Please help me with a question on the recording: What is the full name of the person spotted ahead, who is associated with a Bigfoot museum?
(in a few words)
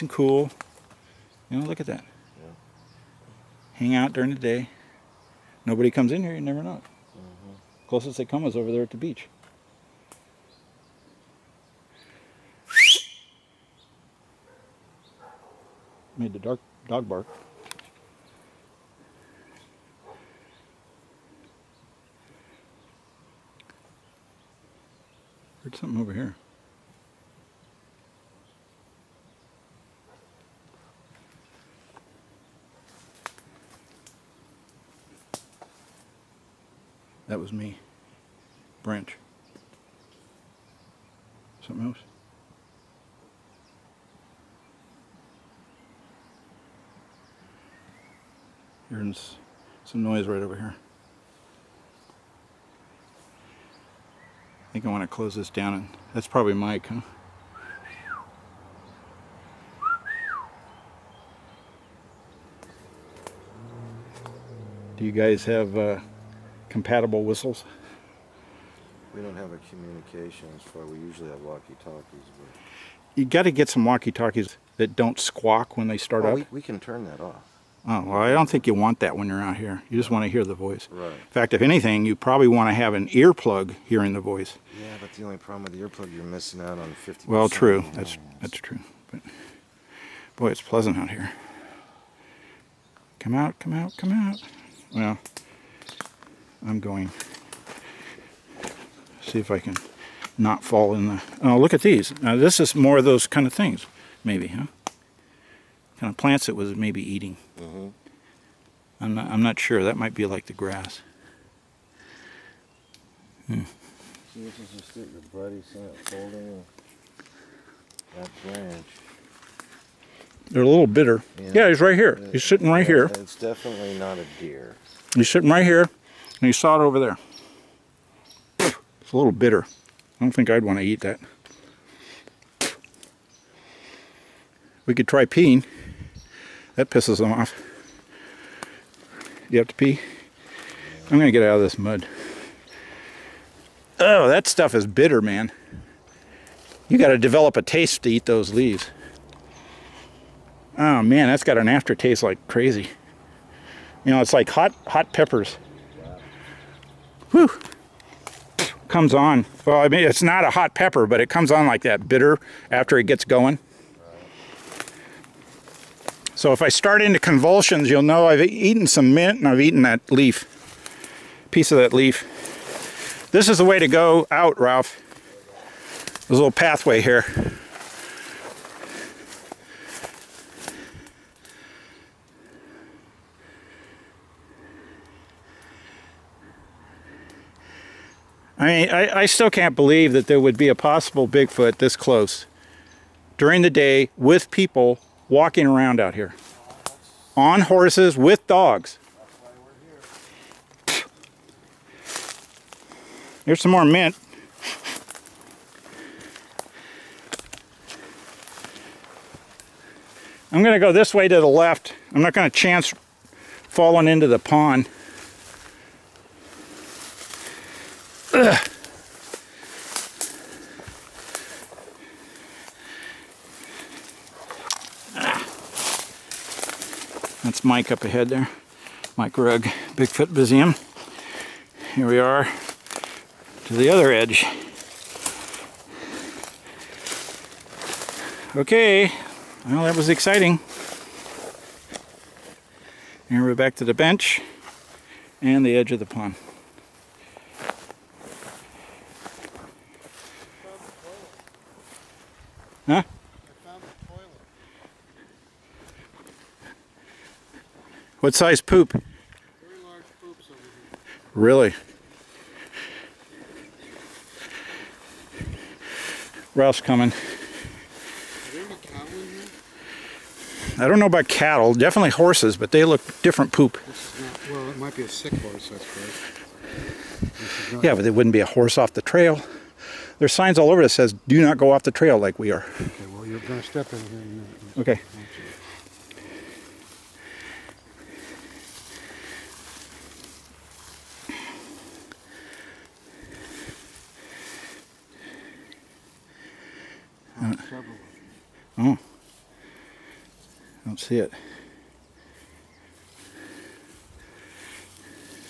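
Mike Rugg.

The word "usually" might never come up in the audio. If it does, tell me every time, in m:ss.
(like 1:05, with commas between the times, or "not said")
1:10.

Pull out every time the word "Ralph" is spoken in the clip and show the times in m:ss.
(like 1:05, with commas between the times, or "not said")
2:54, 4:26.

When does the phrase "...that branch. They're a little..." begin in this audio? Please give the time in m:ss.
1:58.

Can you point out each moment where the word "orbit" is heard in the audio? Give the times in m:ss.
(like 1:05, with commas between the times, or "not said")
not said.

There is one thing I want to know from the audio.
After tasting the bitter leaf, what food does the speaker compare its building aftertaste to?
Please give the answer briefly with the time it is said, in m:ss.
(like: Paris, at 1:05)
hot peppers, at 2:34.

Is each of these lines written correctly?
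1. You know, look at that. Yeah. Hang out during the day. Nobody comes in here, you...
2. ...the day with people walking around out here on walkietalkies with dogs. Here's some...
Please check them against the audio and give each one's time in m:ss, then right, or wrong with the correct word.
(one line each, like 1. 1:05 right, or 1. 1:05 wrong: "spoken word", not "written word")
1. 0:01 right
2. 3:13 wrong: "horses", not "walkietalkies".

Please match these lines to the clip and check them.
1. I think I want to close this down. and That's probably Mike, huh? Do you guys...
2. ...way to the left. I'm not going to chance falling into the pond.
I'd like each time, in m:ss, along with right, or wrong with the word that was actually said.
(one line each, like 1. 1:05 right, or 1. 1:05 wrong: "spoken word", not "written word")
1. 0:54 right
2. 3:31 right.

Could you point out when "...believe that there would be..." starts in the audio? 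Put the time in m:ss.
3:09.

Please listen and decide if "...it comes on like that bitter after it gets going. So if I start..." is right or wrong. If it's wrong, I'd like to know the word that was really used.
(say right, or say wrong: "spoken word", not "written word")
right.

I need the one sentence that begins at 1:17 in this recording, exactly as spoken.
Oh, well, I don't think you want that when you're out here.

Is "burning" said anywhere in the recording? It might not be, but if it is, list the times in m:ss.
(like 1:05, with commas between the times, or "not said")
not said.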